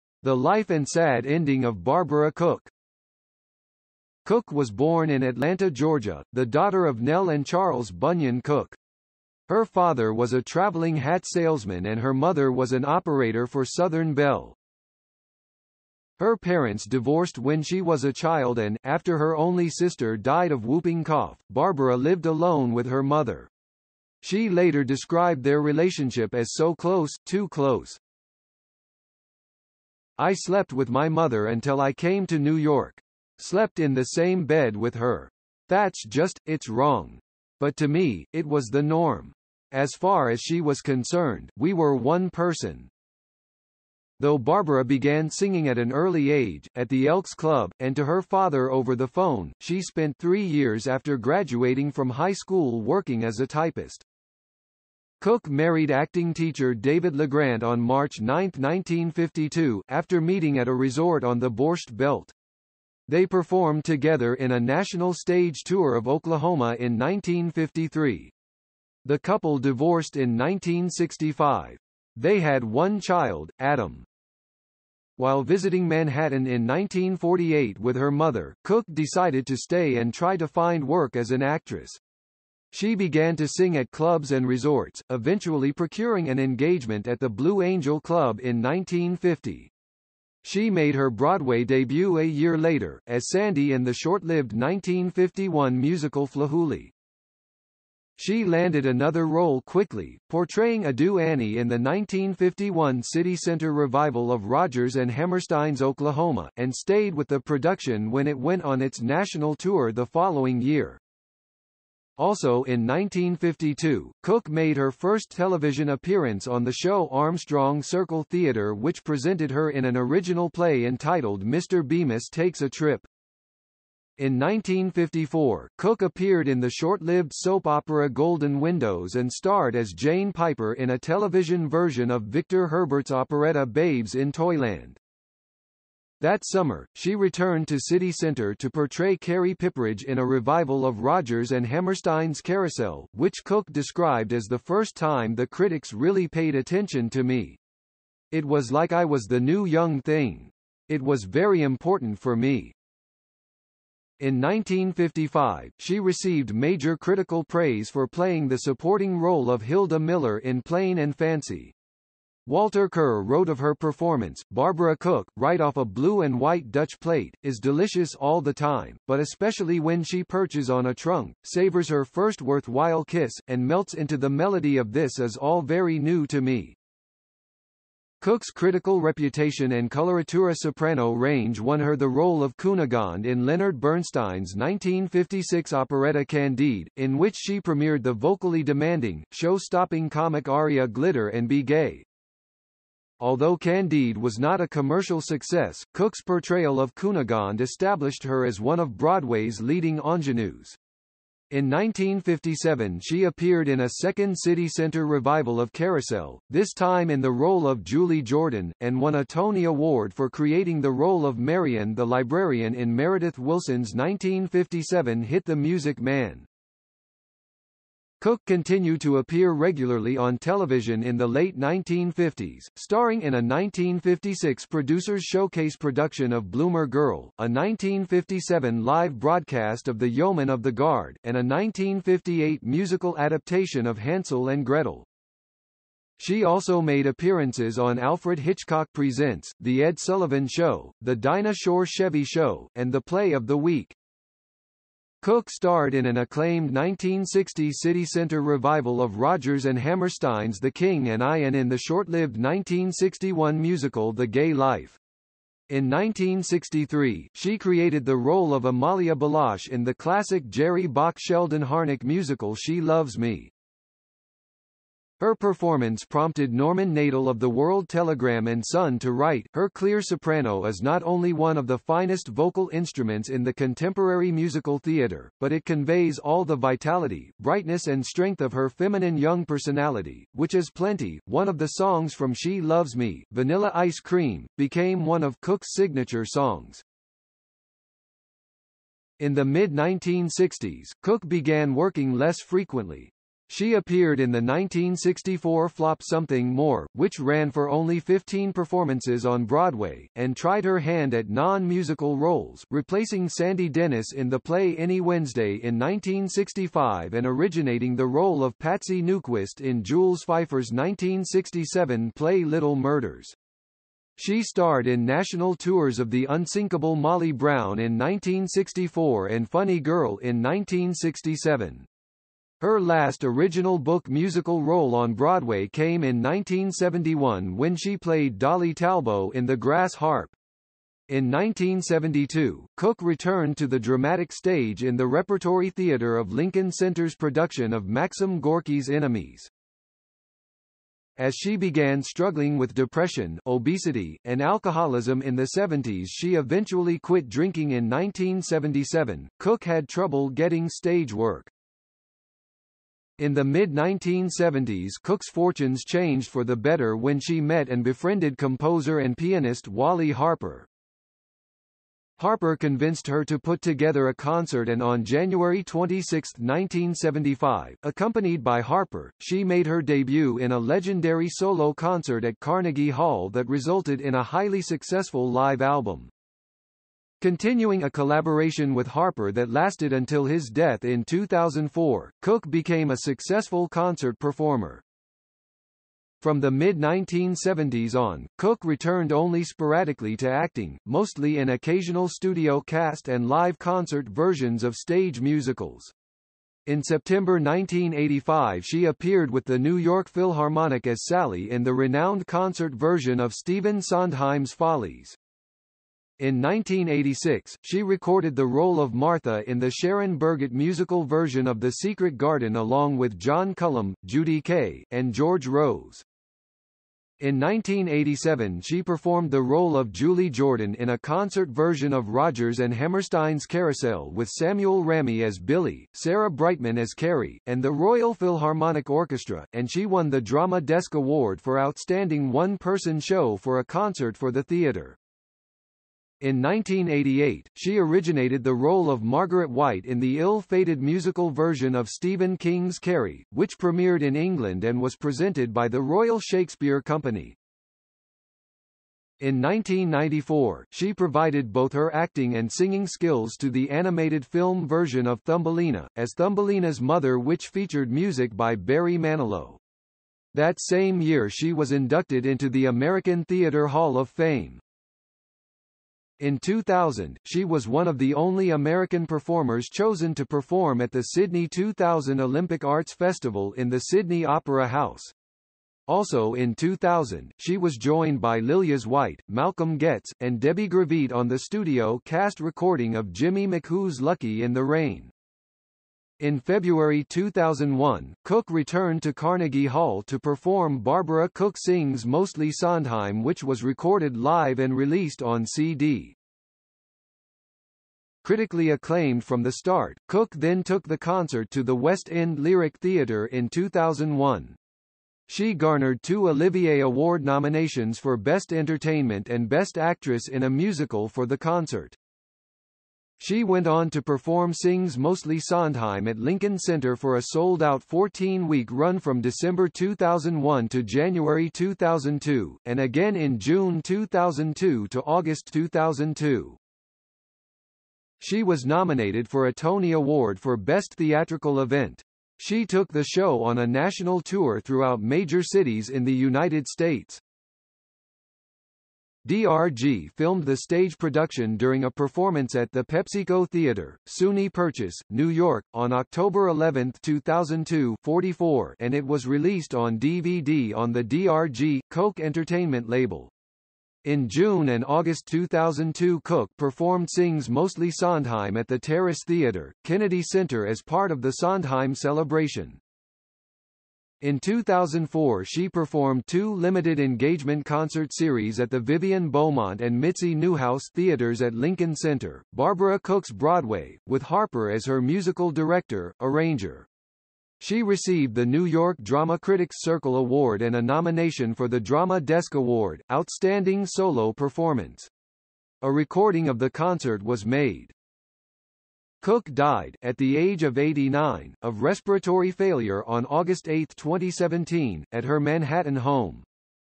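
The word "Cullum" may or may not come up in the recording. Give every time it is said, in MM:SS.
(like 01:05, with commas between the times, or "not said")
06:53.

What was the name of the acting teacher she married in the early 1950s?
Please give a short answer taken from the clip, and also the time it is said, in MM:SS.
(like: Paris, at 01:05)
David Legrand, at 00:56.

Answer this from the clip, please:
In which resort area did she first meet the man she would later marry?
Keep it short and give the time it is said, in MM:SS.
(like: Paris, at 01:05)
Borscht Belt, at 01:01.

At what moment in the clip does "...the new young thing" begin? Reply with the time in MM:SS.
02:29.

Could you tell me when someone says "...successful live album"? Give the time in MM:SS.
06:14.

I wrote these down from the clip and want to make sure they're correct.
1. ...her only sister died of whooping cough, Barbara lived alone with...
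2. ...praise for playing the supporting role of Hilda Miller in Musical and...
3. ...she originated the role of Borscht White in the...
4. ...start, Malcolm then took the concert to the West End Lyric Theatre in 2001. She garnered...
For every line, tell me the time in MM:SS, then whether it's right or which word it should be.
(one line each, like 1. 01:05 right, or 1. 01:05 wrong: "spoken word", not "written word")
1. 00:19 right
2. 02:37 wrong: "Plain", not "Musical"
3. 07:17 wrong: "Margaret", not "Borscht"
4. 08:19 wrong: "Cook", not "Malcolm".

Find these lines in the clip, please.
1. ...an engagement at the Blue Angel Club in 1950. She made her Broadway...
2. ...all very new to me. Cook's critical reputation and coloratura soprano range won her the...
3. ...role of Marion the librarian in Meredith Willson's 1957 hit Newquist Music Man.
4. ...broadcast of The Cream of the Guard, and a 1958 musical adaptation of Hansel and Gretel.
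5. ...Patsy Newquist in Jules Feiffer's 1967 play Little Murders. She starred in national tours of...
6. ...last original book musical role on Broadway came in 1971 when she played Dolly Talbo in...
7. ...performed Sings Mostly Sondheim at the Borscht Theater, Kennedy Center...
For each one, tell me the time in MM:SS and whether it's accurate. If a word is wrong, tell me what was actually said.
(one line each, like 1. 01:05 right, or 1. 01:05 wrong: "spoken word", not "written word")
1. 01:26 right
2. 02:55 right
3. 03:30 wrong: "The", not "Newquist"
4. 03:49 wrong: "Yeoman", not "Cream"
5. 05:08 right
6. 05:22 right
7. 09:16 wrong: "Terrace", not "Borscht".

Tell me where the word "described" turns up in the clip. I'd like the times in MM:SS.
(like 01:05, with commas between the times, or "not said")
00:24, 02:23.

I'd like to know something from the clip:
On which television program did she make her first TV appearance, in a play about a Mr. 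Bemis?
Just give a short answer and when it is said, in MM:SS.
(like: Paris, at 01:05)
Armstrong Circle Theatre, at 01:57.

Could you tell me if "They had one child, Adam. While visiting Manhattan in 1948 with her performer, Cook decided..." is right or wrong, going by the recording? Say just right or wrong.
wrong.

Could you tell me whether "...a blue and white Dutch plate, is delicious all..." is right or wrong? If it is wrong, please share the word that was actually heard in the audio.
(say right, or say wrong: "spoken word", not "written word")
right.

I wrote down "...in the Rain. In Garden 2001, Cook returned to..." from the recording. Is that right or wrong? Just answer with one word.
wrong.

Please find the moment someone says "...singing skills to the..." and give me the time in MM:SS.
07:32.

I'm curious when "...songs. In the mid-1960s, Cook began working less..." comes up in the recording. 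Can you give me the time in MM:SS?
04:46.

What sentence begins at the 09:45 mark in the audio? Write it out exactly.
A recording of the concert was made.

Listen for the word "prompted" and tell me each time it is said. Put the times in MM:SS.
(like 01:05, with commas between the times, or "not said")
04:26.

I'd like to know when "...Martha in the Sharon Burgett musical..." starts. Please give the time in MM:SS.
06:48.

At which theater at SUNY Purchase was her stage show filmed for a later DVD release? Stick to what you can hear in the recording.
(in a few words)
PepsiCo Theater.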